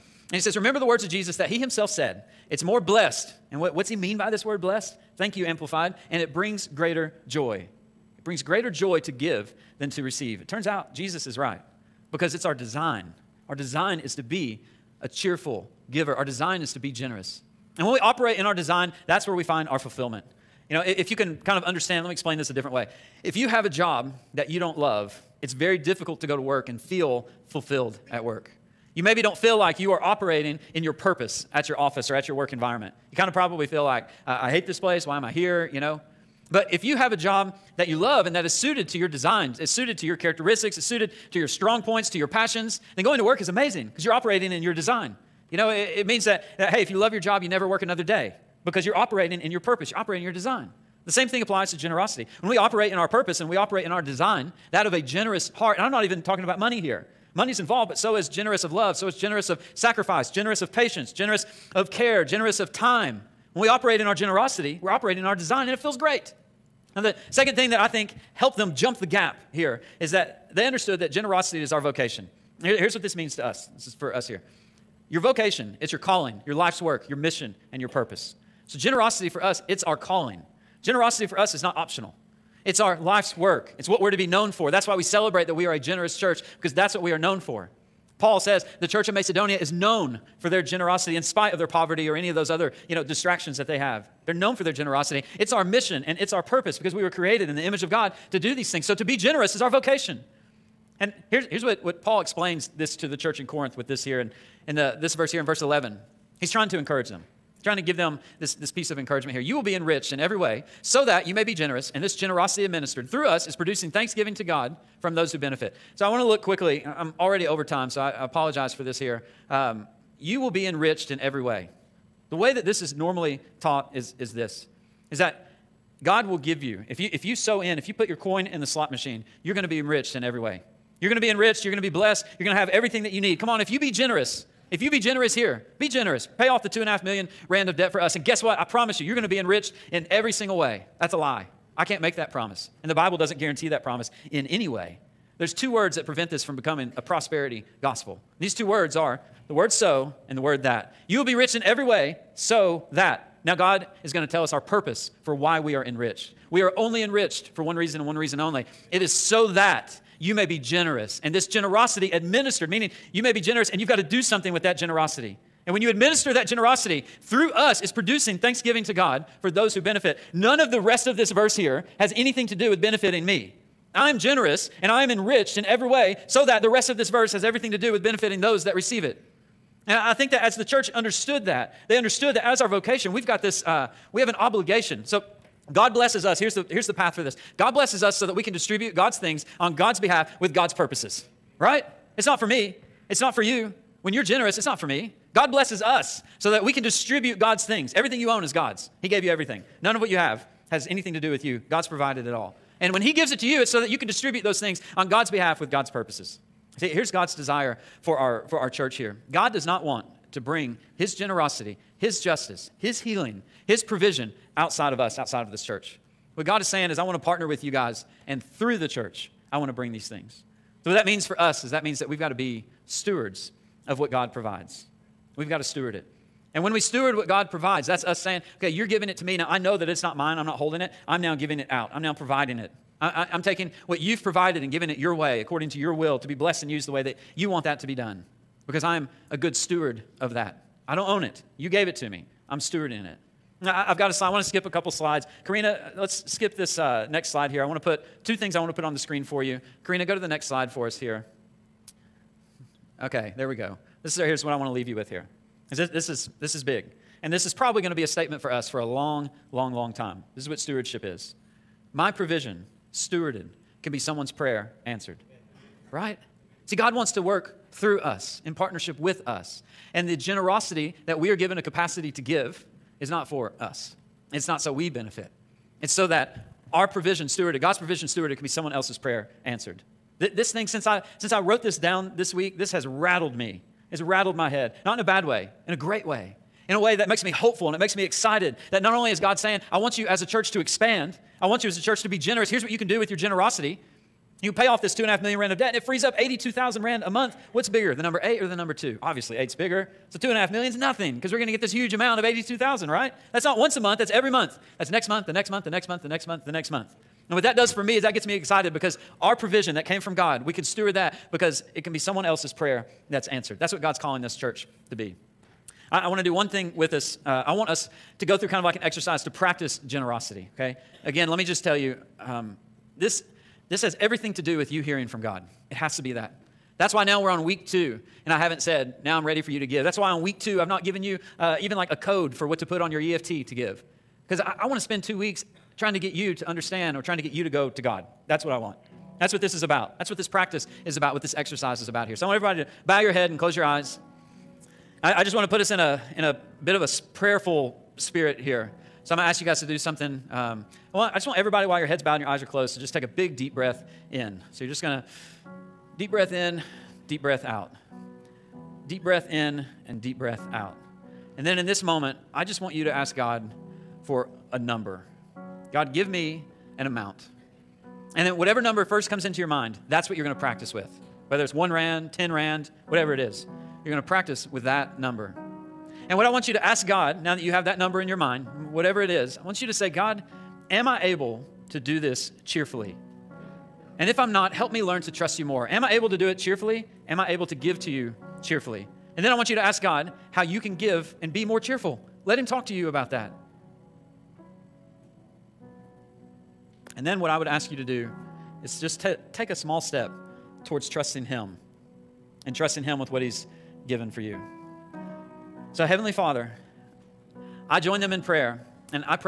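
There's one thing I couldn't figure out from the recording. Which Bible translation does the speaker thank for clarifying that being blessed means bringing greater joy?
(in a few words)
Amplified.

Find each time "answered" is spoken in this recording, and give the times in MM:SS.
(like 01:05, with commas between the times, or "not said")
04:24, 04:39, 05:13.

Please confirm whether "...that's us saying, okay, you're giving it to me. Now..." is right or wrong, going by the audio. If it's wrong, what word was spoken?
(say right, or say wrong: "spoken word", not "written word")
right.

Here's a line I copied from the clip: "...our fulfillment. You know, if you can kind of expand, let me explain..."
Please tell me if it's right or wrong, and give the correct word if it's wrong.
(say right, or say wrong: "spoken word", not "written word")
wrong: "understand", not "expand".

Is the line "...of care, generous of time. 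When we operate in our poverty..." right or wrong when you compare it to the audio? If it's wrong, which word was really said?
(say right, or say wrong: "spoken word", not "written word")
wrong: "generosity", not "poverty".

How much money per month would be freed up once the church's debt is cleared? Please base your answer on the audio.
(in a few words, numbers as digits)
82,000 rand.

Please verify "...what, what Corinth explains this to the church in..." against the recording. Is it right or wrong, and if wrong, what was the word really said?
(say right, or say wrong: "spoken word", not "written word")
wrong: "Paul", not "Corinth".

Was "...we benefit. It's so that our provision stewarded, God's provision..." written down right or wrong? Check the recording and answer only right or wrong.
right.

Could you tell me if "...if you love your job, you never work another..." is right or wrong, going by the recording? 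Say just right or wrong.
right.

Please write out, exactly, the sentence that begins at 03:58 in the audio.
Because I'm a good steward of that.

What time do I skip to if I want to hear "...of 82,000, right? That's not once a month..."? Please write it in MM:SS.
05:02.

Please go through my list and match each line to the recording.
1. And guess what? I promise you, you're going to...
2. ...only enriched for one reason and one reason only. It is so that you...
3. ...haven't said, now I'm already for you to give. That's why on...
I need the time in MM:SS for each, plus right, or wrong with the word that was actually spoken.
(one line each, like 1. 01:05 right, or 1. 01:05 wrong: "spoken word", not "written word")
1. 02:18 right
2. 02:36 right
3. 05:28 wrong: "ready", not "already".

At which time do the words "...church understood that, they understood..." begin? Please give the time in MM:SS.
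03:00.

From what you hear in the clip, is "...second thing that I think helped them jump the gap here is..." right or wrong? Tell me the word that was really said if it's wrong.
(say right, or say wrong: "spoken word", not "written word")
right.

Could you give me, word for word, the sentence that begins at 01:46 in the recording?
He's trying to encourage them trying to give them this, this piece of encouragement here.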